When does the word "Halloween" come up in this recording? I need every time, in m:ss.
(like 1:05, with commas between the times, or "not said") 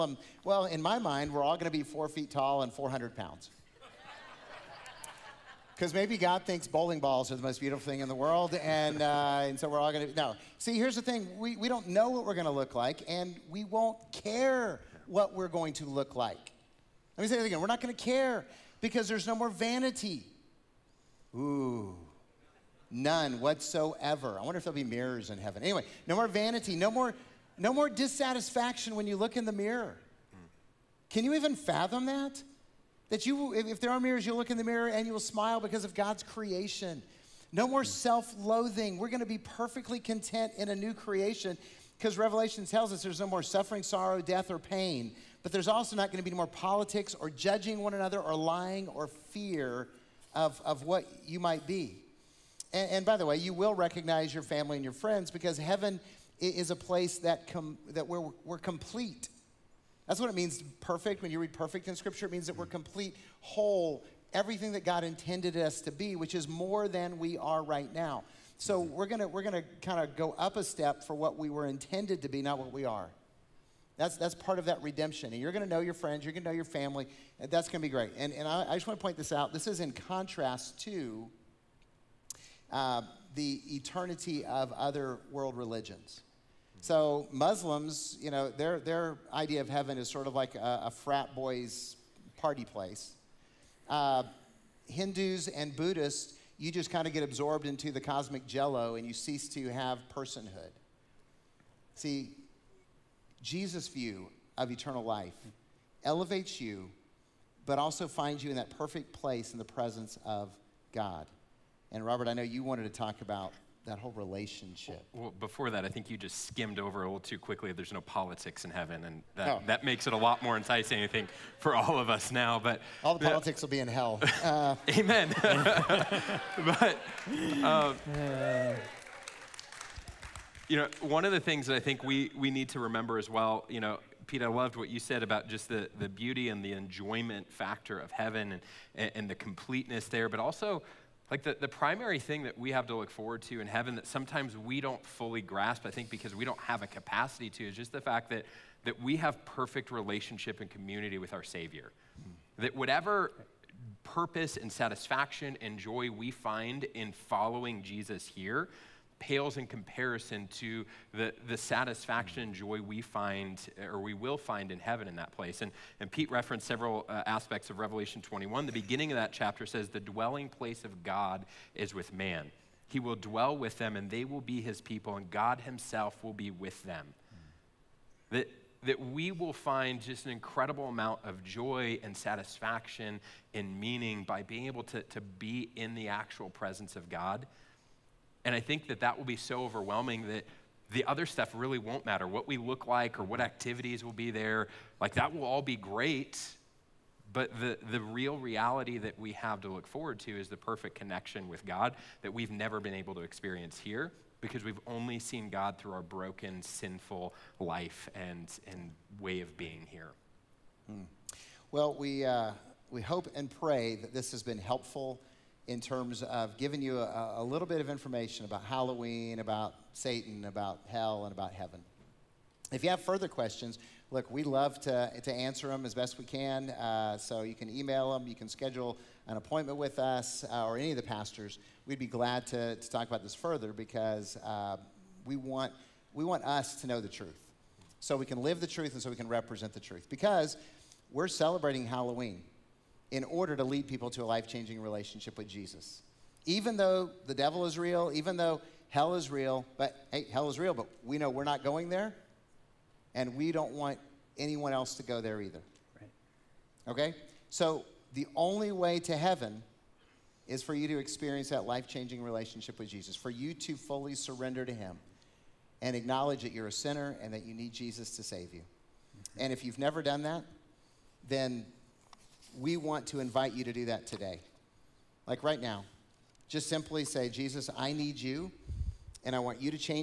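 3:38, 4:01.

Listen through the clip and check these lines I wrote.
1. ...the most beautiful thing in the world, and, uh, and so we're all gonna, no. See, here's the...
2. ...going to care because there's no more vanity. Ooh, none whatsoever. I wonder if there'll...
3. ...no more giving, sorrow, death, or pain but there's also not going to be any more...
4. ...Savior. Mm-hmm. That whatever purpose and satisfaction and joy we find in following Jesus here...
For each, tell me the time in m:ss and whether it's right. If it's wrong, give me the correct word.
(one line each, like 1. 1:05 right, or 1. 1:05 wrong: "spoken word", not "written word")
1. 0:07 right
2. 0:17 right
3. 0:43 wrong: "suffering", not "giving"
4. 2:31 right.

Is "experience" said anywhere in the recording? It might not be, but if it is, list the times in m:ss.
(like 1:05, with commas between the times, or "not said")
3:23, 4:20.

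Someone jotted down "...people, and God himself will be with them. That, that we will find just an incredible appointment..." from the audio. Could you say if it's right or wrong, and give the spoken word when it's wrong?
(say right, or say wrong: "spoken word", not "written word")
wrong: "amount", not "appointment".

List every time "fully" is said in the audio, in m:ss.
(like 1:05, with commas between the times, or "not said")
2:25, 4:23.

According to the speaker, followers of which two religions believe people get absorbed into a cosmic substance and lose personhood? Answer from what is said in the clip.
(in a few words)
Hindus and Buddhists.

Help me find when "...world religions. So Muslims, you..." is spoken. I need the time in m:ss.
1:25.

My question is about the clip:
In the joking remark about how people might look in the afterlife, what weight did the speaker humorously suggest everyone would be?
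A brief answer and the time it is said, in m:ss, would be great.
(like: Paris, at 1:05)
400 pounds, at 0:02.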